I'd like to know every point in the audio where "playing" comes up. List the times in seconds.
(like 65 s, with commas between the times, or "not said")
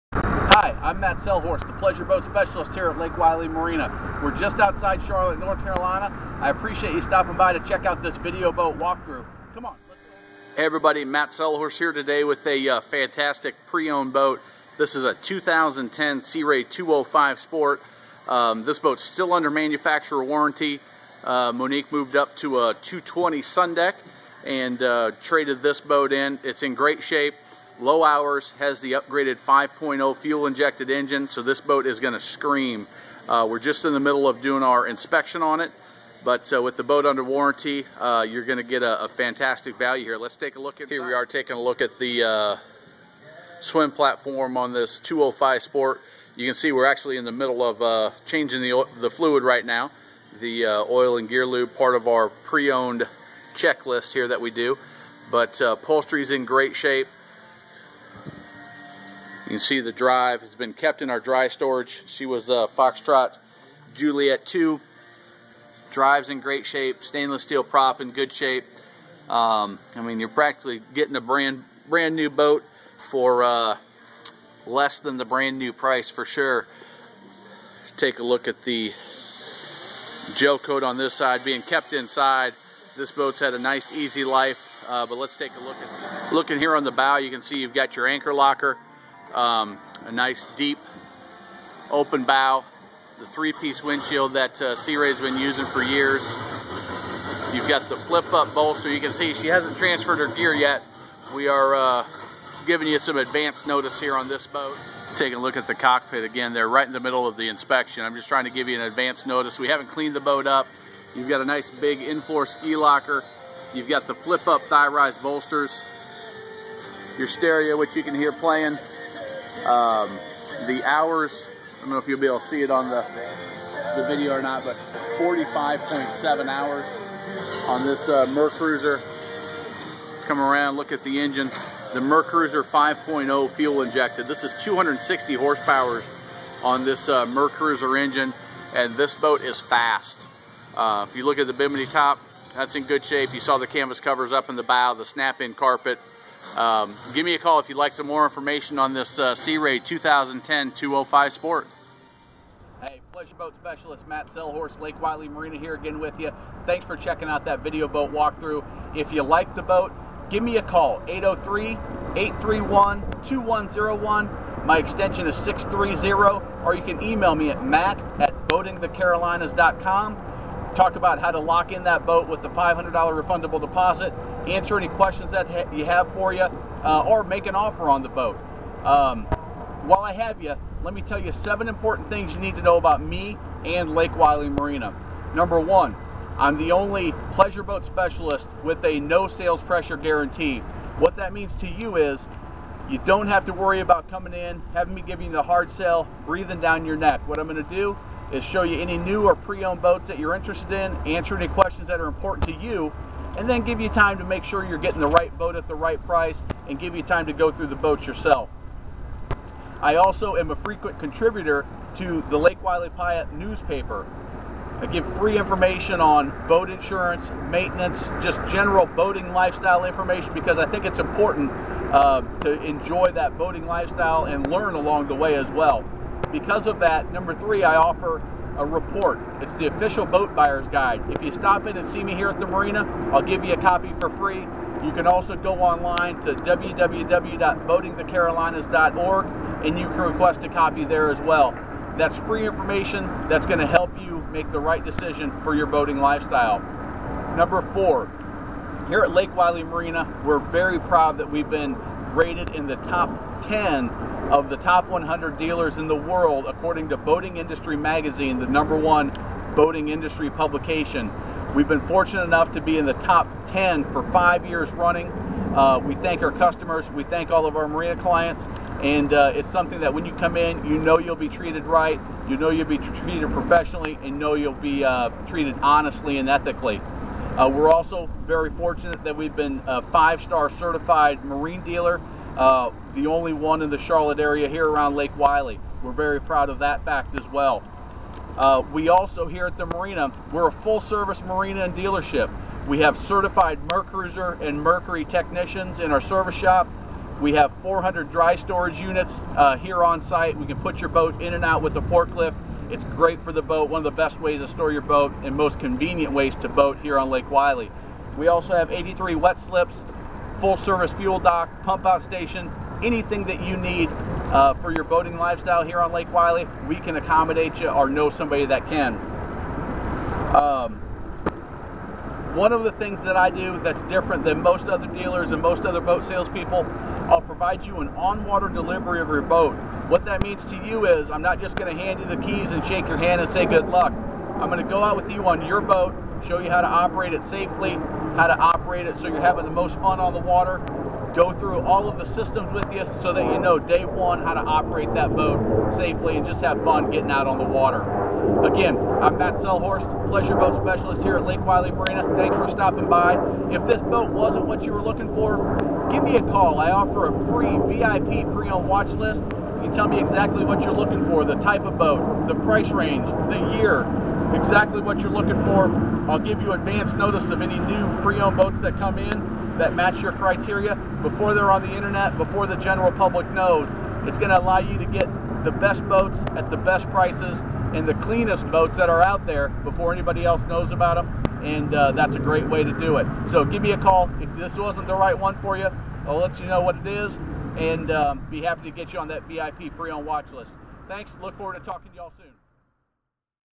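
118 s.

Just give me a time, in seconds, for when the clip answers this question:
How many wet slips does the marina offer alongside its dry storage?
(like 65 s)
308 s.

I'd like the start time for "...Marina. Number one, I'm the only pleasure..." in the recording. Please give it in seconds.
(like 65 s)
184 s.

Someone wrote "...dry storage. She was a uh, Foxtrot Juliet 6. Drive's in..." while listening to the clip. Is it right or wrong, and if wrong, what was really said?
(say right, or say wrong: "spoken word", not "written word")
wrong: "2", not "6".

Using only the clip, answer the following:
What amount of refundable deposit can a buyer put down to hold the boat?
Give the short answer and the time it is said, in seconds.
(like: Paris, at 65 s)
$500, at 172 s.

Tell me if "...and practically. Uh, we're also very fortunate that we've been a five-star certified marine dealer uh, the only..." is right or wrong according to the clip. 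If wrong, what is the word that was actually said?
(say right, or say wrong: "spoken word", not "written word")
wrong: "ethically", not "practically".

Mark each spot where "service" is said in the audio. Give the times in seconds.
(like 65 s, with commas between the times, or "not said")
290 s, 295 s, 310 s.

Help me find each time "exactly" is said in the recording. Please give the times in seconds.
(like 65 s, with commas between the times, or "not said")
359 s, 364 s.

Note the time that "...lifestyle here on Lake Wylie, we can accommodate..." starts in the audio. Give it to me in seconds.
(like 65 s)
315 s.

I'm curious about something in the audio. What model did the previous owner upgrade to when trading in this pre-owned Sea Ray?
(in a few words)
220 Sun Deck.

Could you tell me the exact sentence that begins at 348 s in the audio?
Again, I'm Matt Sellhorst, Pleasure Boat Specialist here at Lake Wylie Marina.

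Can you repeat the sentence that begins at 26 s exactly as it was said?
It's in great shape low hours, has the upgraded 5.0 fuel injected engine, so this boat is going to scream.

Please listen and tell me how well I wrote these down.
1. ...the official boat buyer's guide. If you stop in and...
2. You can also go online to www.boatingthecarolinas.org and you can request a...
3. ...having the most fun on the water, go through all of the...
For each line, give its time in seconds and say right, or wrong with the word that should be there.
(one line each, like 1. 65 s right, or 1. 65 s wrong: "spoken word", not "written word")
1. 229 s right
2. 234 s right
3. 339 s right.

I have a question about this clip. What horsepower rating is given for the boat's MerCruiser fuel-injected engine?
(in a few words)
260.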